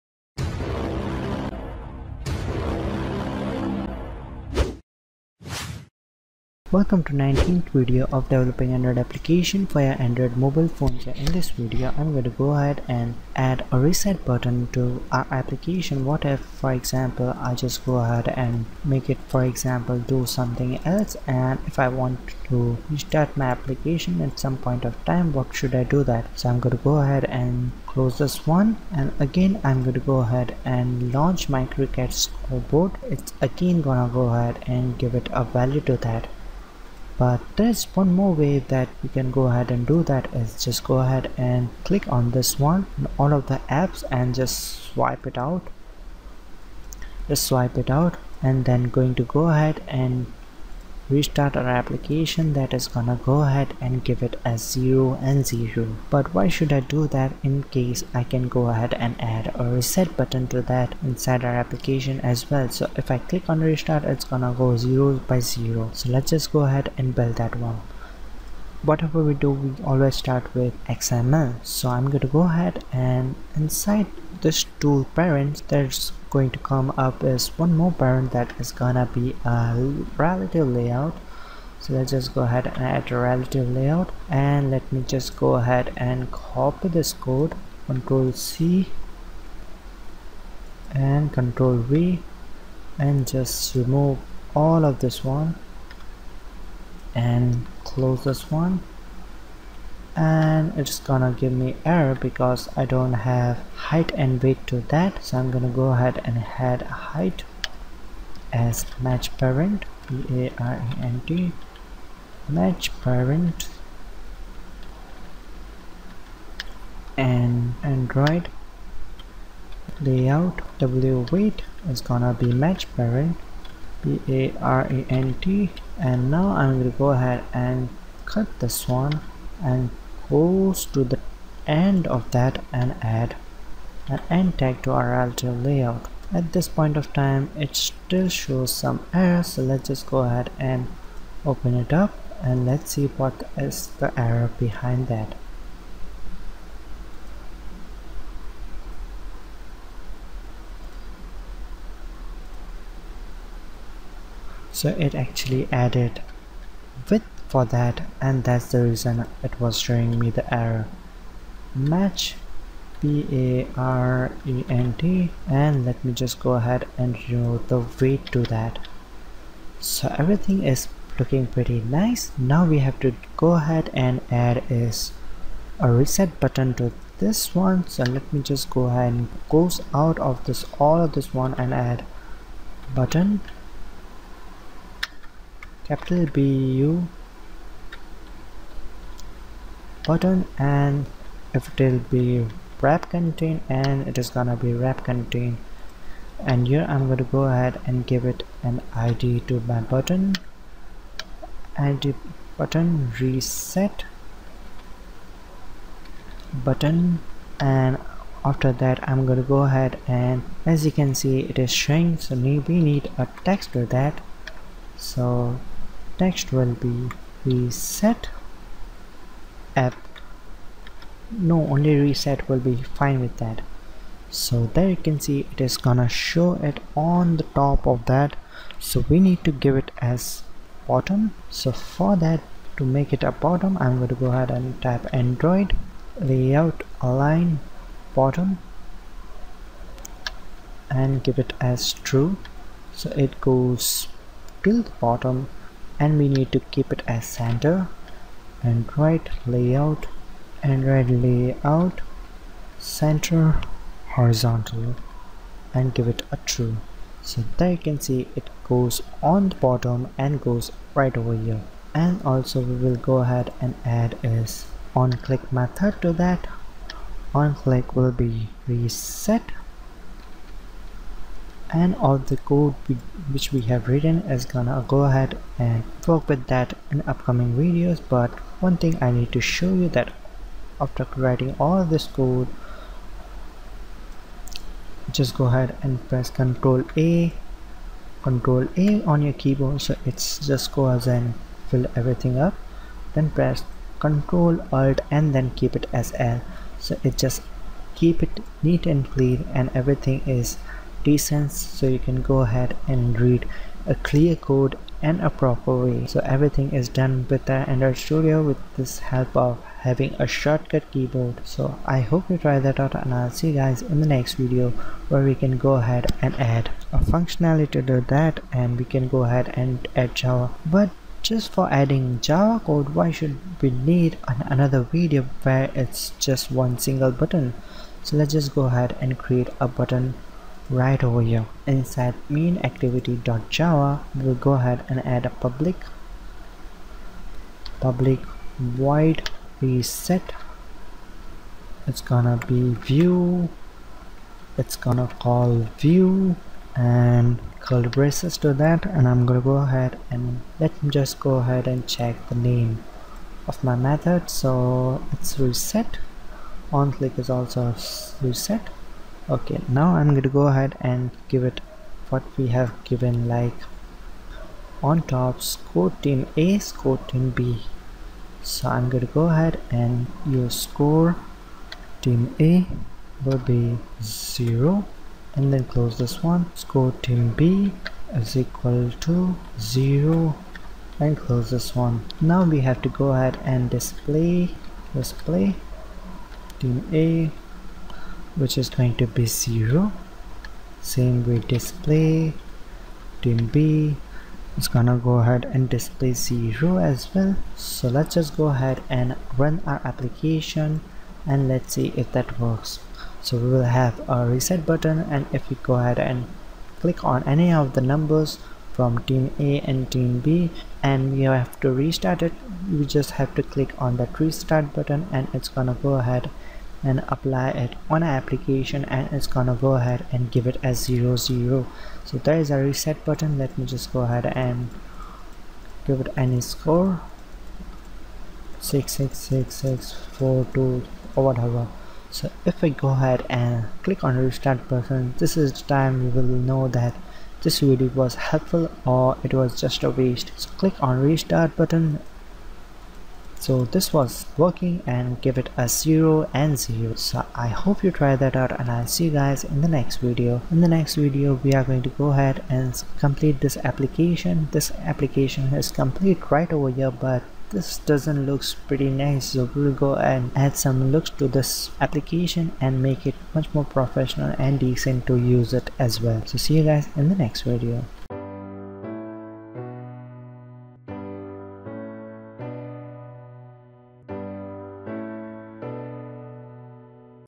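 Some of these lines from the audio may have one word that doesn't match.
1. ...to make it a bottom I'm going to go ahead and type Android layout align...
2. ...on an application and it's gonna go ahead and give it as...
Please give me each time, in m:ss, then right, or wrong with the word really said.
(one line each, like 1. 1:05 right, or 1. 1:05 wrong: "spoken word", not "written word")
1. 3:52 right
2. 6:57 right.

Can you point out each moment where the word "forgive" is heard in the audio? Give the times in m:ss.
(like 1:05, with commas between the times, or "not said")
not said.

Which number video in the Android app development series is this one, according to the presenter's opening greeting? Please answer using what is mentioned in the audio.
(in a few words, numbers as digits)
19th.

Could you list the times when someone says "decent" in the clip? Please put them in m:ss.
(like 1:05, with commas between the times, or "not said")
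5:01, 7:44.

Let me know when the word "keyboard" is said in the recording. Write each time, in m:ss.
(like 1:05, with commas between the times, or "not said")
4:49, 5:10.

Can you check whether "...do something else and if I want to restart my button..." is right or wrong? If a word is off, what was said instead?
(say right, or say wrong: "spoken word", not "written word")
wrong: "application", not "button".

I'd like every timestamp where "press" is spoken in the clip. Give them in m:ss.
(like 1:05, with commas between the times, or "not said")
4:46, 4:53.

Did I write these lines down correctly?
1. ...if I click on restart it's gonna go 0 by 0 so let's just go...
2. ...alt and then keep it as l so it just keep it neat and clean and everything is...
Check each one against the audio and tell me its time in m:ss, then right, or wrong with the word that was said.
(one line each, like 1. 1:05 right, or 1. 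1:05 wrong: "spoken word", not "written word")
1. 1:02 right
2. 4:54 right.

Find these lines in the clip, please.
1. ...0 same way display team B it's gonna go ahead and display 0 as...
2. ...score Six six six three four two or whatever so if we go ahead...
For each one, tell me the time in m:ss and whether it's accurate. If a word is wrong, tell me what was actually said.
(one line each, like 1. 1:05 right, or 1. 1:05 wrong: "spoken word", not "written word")
1. 6:29 right
2. 7:06 wrong: "six", not "three".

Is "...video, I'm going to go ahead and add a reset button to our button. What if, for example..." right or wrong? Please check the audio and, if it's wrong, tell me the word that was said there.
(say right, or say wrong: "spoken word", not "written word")
wrong: "application", not "button".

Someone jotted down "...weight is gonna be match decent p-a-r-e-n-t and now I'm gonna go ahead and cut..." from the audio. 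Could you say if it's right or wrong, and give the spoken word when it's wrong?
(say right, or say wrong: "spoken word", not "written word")
wrong: "parent", not "decent".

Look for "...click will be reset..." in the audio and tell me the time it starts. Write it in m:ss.
4:27.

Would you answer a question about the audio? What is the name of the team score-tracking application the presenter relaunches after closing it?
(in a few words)
cricket scoreboard.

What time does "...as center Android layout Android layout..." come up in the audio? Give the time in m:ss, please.
4:07.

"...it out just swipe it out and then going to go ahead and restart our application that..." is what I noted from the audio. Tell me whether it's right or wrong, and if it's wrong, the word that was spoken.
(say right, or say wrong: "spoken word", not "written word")
right.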